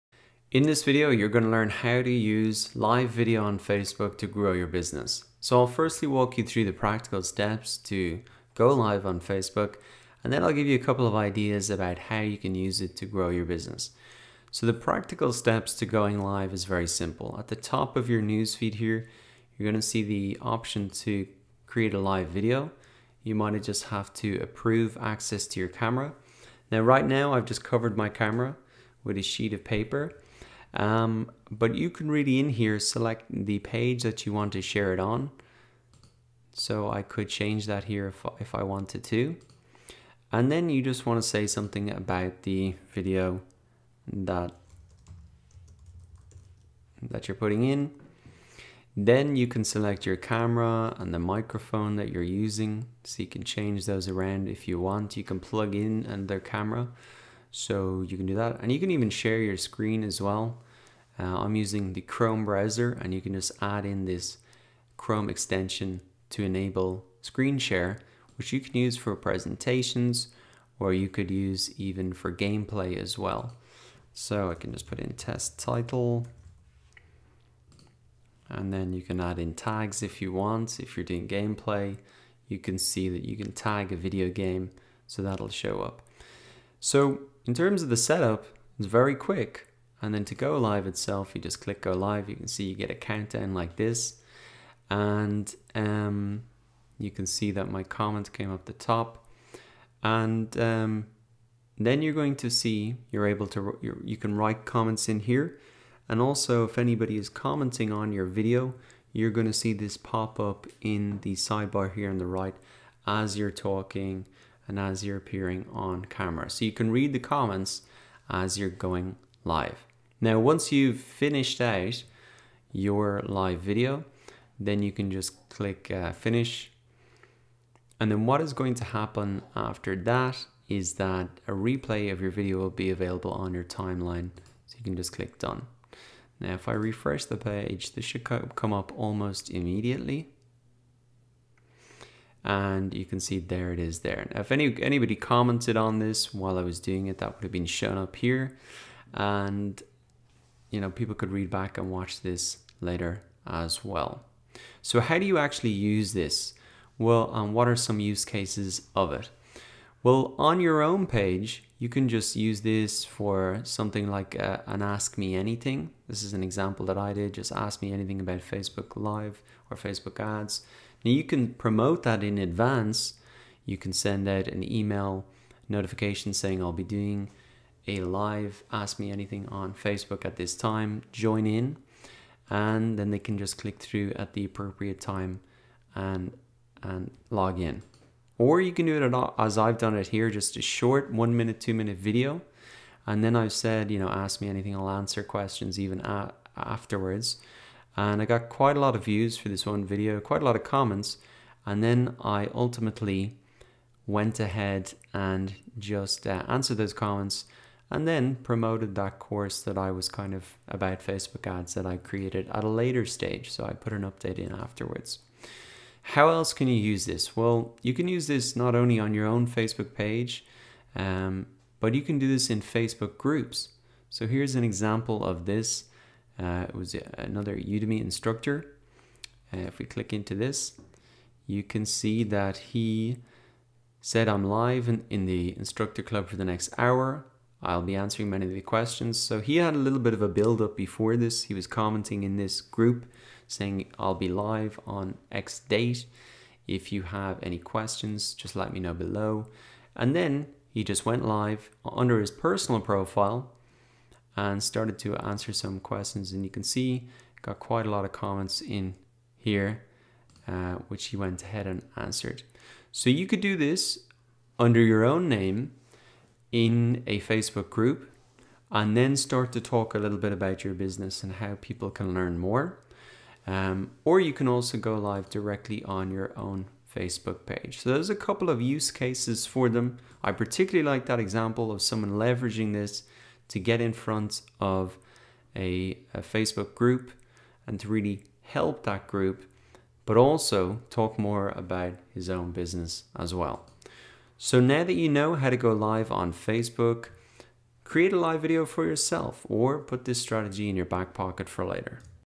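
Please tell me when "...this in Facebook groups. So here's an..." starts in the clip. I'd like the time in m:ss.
3:42.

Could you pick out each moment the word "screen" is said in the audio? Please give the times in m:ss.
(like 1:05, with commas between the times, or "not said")
0:59, 1:07.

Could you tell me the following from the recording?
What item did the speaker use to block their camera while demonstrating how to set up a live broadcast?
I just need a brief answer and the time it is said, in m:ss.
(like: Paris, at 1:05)
A sheet of paper, at 0:29.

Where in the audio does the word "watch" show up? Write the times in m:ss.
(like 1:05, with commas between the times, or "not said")
2:31.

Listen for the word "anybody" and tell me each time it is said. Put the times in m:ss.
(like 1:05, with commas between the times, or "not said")
1:46, 2:24.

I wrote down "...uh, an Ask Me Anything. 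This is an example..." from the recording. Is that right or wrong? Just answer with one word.
right.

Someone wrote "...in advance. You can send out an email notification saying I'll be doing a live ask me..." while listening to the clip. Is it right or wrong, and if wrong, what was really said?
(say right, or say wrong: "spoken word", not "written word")
right.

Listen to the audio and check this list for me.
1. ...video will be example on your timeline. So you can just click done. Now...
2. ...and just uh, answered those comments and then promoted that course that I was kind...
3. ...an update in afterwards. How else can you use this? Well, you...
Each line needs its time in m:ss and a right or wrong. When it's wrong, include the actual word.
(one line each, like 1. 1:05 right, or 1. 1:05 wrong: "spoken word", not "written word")
1. 2:12 wrong: "available", not "example"
2. 3:25 right
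3. 3:33 right.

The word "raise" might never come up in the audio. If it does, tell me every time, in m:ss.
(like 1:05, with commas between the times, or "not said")
not said.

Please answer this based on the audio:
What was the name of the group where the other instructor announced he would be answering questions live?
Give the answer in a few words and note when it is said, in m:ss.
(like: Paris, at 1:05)
instructor club, at 3:55.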